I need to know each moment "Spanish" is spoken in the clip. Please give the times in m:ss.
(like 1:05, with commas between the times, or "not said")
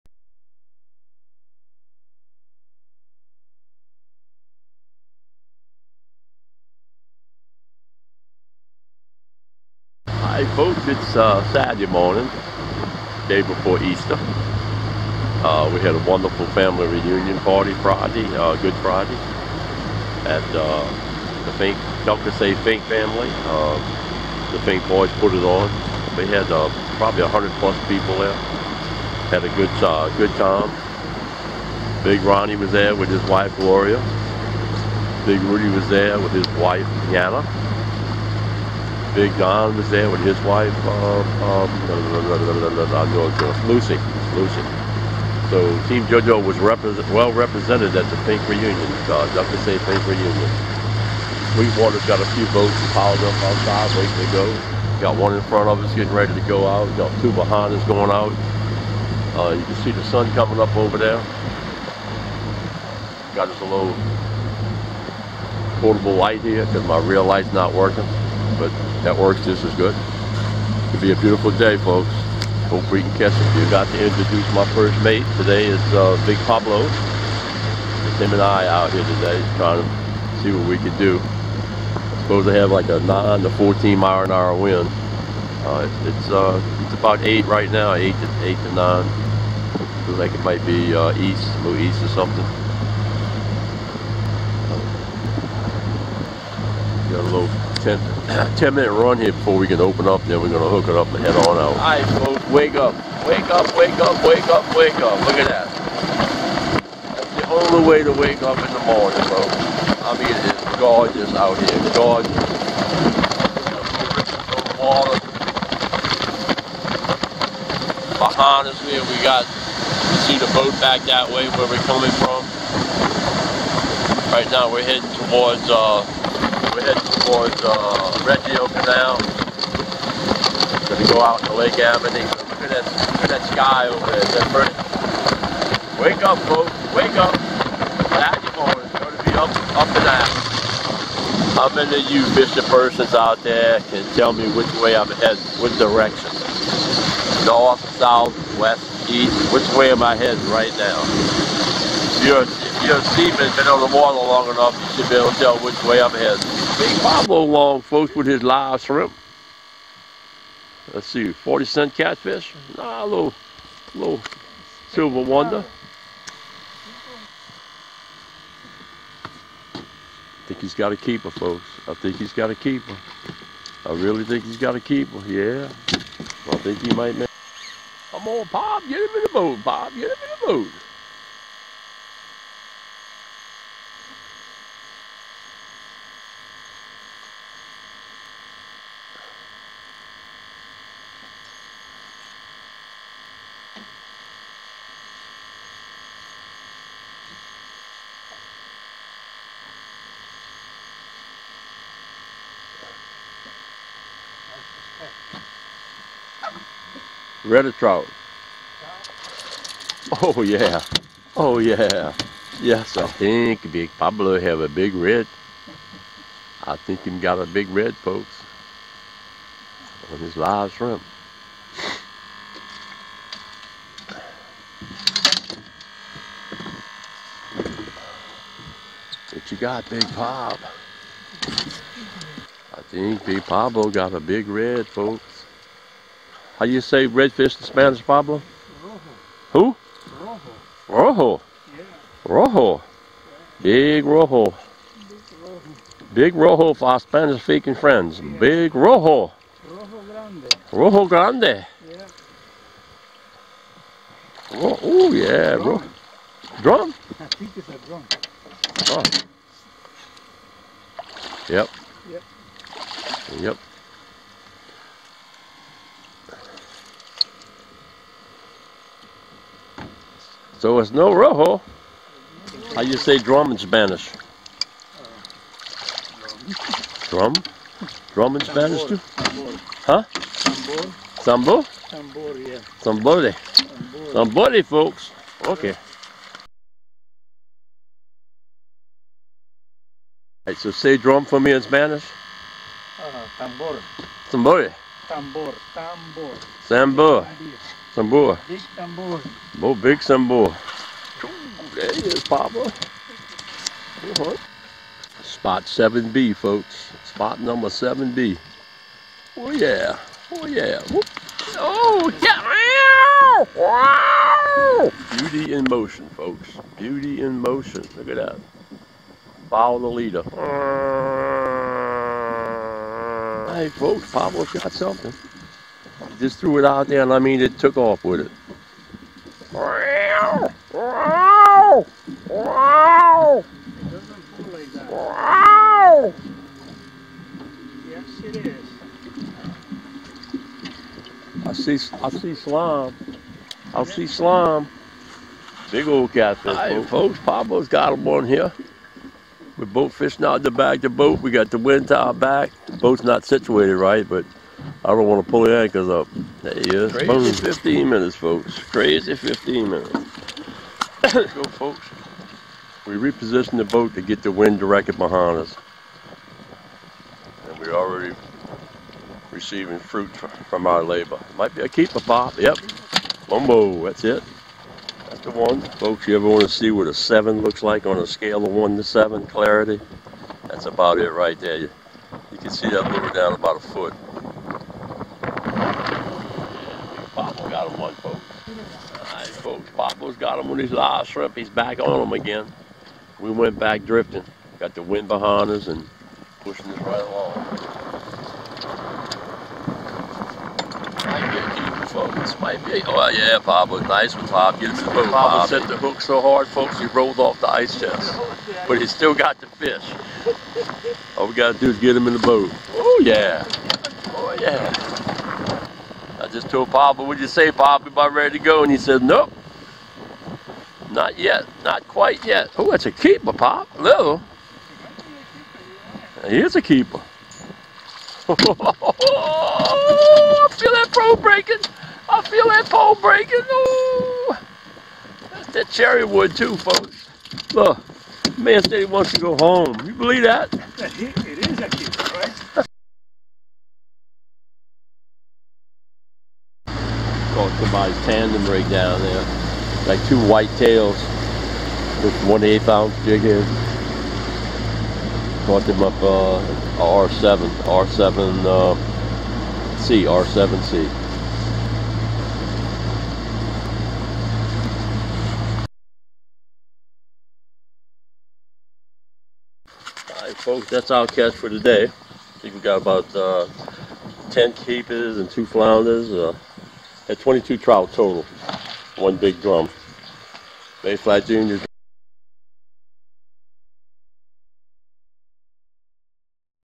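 3:57, 4:06, 4:33, 4:38, 4:51.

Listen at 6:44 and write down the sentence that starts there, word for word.
Get him the boat, Papa set the hook so hard, folks, he rolled off the ice chest.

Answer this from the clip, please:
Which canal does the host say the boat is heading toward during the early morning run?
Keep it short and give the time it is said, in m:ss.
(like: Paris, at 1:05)
Reggio Canal, at 2:08.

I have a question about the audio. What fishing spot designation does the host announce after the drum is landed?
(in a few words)
Spot 7B.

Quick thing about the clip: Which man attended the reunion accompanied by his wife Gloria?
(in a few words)
Big Ronnie.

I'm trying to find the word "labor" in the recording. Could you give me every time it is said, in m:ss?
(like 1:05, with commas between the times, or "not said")
6:10.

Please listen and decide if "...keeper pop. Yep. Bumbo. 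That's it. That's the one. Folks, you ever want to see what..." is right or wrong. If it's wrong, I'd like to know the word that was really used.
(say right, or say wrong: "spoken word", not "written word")
right.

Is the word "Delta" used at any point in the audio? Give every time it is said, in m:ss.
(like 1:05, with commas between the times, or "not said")
0:22.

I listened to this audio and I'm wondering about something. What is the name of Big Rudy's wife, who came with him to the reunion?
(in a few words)
Yana.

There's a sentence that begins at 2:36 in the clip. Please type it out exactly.
Big along, folks, with his live shrimp.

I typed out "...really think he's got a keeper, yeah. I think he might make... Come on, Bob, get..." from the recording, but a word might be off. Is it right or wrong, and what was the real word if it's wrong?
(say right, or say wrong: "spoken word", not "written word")
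right.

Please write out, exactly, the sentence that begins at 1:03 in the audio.
Got us a little portable light here because my real light's not working but that works just as good.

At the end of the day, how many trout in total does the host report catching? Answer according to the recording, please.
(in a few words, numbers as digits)
22.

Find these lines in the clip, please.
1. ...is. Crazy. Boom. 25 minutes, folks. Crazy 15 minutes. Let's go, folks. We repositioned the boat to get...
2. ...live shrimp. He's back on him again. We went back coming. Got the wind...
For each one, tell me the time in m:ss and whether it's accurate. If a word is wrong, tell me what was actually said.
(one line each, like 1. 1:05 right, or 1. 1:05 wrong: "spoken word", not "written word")
1. 5:56 wrong: "15", not "25"
2. 6:30 wrong: "drifting", not "coming".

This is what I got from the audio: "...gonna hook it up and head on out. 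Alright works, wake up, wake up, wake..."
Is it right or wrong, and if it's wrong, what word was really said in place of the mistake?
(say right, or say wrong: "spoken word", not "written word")
wrong: "folks", not "works".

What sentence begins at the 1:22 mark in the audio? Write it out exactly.
supposed to have like a 9 to 14 mile an hour wind.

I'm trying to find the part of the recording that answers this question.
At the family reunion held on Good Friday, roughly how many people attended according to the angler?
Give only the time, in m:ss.
0:27.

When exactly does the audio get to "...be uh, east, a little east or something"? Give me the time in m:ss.
1:30.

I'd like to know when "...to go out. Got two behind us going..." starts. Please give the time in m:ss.
0:56.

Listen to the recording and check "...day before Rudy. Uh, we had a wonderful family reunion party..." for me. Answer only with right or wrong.
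wrong.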